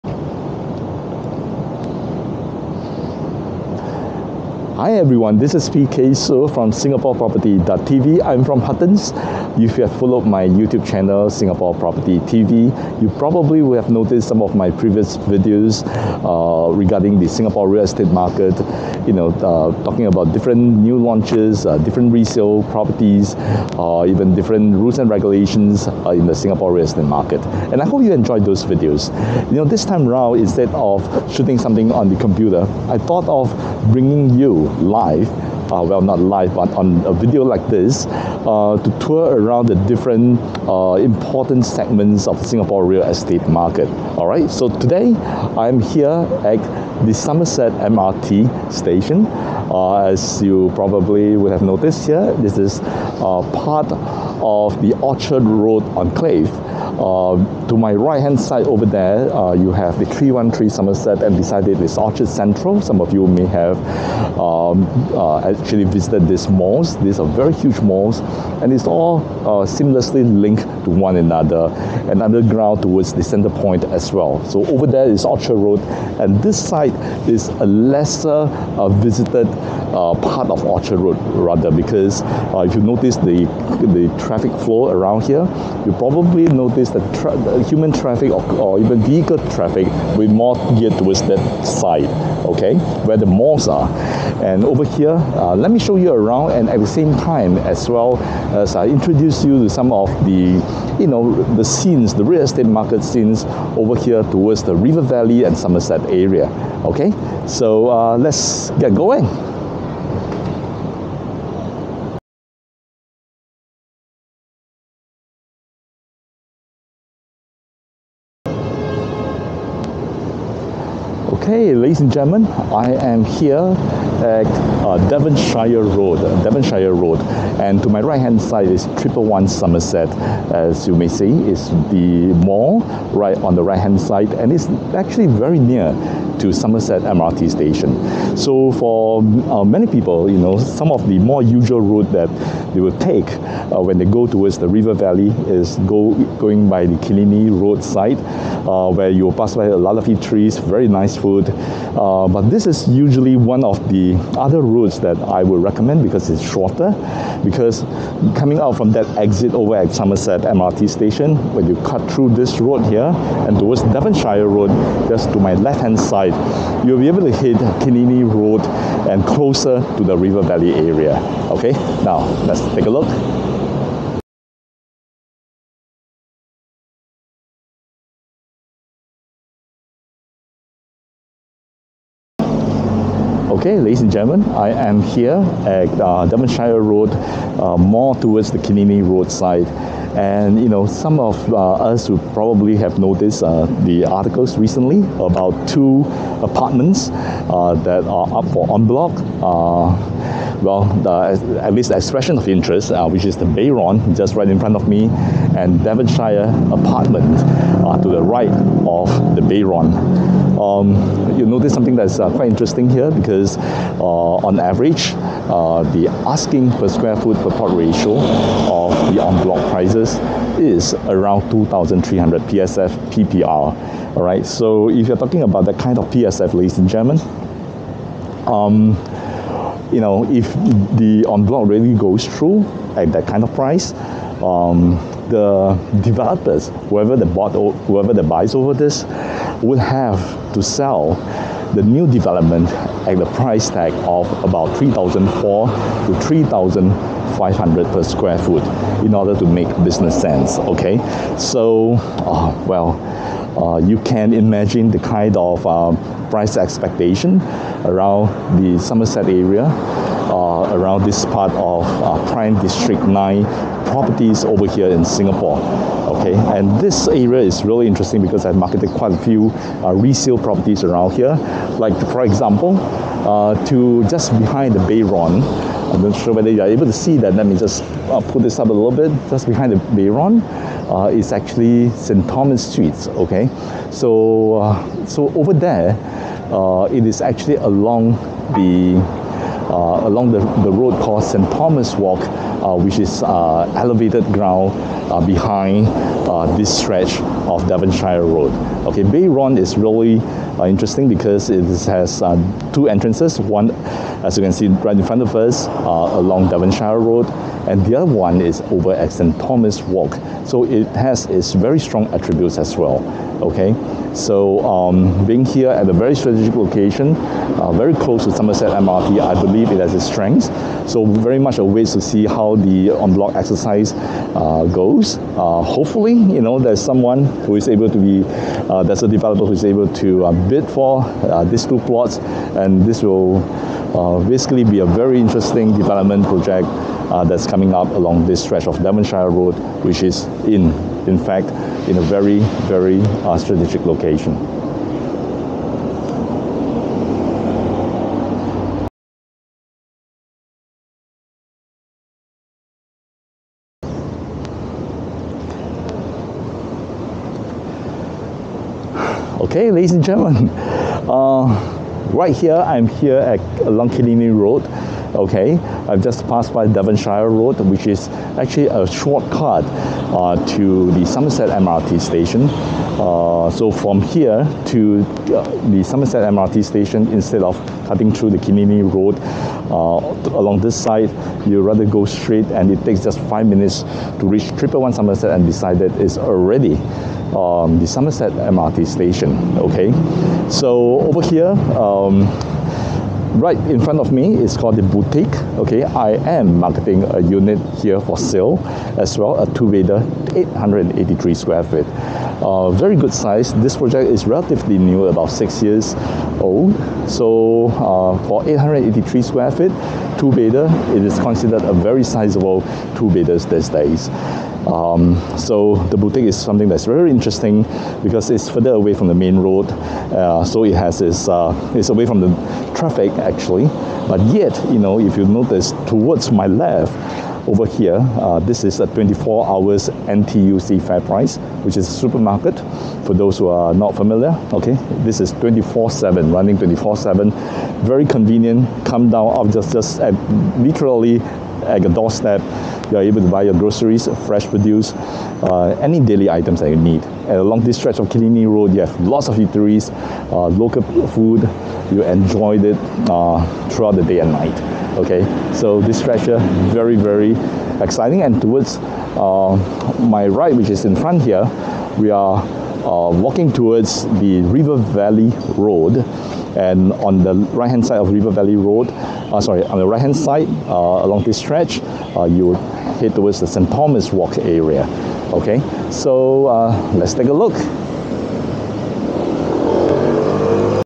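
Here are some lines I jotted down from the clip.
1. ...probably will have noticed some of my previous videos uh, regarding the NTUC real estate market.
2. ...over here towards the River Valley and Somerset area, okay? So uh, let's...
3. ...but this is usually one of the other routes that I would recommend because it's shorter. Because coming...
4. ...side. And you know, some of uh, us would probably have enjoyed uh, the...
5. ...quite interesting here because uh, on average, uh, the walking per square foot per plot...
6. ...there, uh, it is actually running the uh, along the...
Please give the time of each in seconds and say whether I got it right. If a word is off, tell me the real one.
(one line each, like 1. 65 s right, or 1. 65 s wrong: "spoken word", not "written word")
1. 13 s wrong: "Singapore", not "NTUC"
2. 103 s right
3. 152 s right
4. 189 s wrong: "noticed", not "enjoyed"
5. 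212 s wrong: "asking", not "walking"
6. 285 s wrong: "along", not "running".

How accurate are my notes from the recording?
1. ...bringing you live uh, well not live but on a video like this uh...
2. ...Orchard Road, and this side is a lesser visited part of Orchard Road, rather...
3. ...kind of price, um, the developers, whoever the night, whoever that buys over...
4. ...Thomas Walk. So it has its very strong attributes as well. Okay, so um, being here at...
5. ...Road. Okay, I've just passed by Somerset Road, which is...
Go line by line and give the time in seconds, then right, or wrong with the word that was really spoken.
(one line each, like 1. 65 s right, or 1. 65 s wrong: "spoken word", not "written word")
1. 33 s right
2. 75 s right
3. 233 s wrong: "bought", not "night"
4. 309 s right
5. 364 s wrong: "Devonshire", not "Somerset".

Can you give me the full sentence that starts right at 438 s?
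Come down, off just just at, literally at the doorstep.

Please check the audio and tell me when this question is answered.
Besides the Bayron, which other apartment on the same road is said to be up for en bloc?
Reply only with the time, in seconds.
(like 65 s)
205 s.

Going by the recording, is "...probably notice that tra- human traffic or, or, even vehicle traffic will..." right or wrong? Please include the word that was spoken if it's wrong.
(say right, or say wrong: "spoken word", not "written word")
right.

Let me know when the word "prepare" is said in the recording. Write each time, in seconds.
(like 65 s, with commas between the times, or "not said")
not said.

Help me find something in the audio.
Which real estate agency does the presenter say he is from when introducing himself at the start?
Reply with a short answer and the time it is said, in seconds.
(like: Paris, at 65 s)
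Huttons, at 8 s.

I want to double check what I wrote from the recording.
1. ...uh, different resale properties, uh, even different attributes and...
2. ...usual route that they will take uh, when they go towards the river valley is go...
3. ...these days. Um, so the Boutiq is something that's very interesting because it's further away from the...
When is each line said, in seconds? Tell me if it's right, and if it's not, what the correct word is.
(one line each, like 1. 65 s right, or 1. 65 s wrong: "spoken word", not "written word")
1. 21 s wrong: "rules", not "attributes"
2. 141 s right
3. 413 s right.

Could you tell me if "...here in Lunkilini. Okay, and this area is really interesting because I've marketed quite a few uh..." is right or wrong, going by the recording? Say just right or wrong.
wrong.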